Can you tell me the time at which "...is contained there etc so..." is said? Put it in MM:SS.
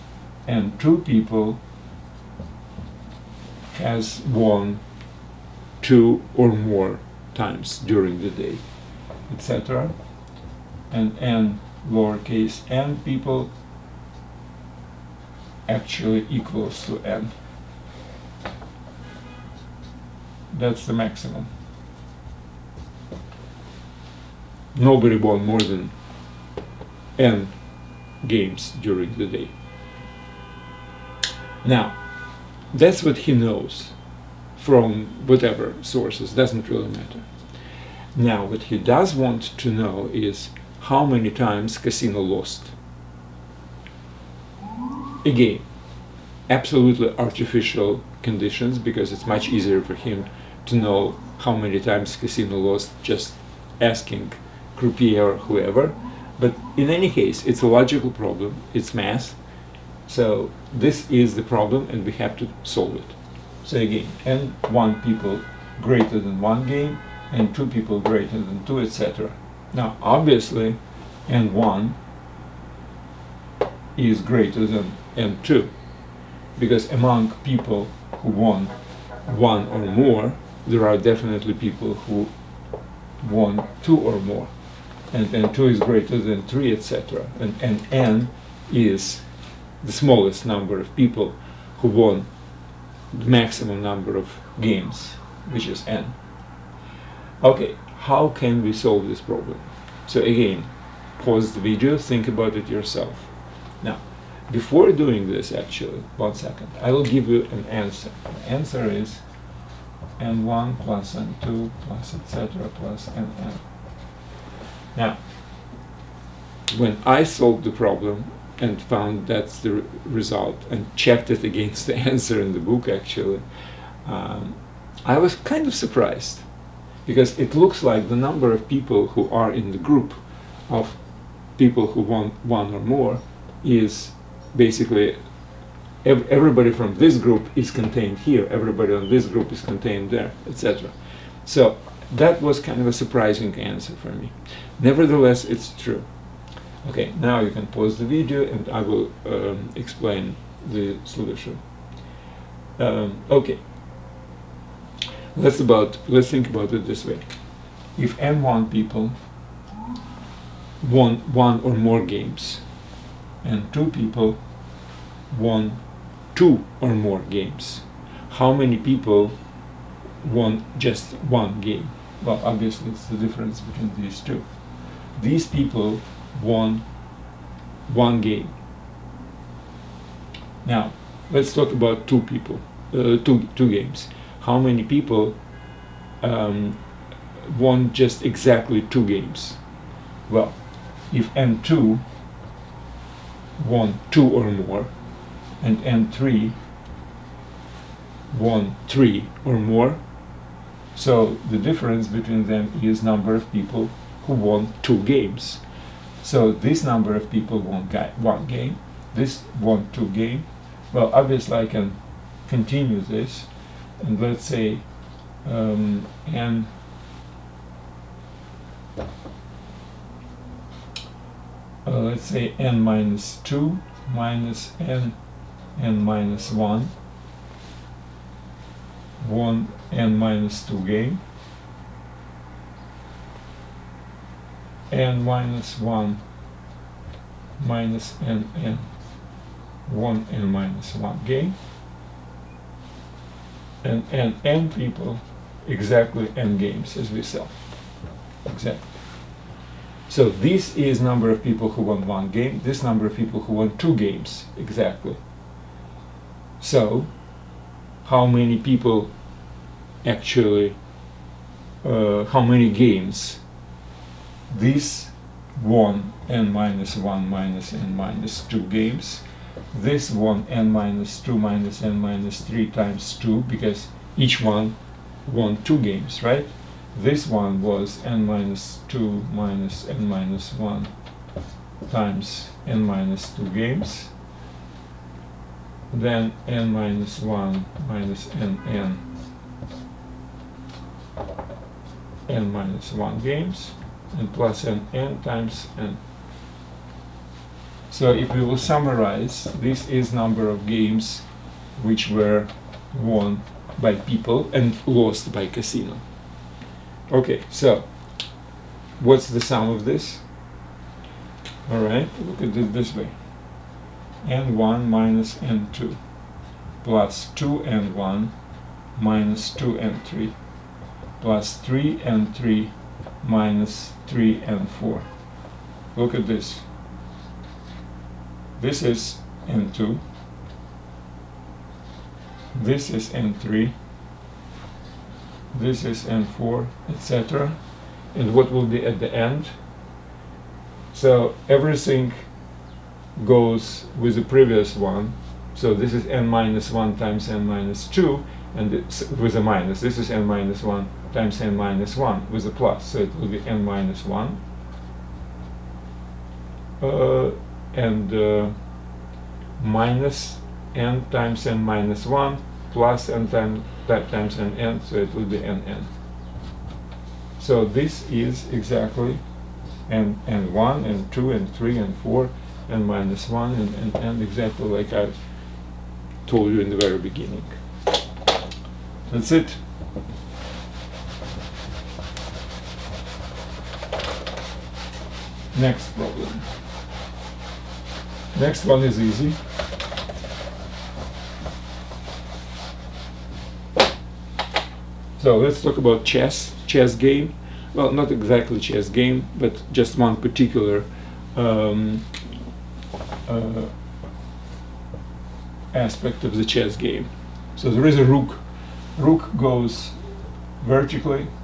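02:19.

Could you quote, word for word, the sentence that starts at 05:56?
Uh, and uh, minus n times n minus 1 plus n time, times n n, so it will be n n.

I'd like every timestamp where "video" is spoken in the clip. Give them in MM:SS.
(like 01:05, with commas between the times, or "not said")
01:41, 02:28.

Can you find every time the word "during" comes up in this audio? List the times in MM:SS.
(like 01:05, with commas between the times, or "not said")
00:07, 00:28.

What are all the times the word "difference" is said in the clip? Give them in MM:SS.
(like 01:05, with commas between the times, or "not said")
02:53, 03:21.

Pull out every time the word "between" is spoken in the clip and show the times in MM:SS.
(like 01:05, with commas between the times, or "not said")
02:53, 03:22.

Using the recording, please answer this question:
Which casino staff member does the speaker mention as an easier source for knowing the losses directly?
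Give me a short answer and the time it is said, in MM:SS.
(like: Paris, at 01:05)
Croupier, at 00:54.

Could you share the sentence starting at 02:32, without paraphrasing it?
Um, okay, let's, about, let's think about it this way.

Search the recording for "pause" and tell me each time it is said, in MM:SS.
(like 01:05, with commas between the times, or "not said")
01:41, 02:27.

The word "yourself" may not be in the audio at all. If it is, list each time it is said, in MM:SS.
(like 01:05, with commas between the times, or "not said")
01:42.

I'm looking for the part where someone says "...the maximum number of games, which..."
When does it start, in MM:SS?
01:33.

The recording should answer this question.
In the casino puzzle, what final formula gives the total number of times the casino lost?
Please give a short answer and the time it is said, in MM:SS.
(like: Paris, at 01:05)
n1 + n2 + ... 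+ nn, at 01:50.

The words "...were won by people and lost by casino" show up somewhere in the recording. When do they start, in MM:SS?
05:02.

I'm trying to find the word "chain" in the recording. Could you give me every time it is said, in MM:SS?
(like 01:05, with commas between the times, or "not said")
not said.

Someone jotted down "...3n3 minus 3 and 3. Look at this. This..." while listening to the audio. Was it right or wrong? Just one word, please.
wrong.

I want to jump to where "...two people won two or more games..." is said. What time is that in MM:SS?
02:43.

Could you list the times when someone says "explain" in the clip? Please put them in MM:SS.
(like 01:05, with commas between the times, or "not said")
02:29.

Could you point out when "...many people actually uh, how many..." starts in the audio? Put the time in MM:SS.
04:18.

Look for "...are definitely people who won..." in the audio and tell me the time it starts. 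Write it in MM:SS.
01:20.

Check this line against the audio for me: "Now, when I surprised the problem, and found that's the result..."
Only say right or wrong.
wrong.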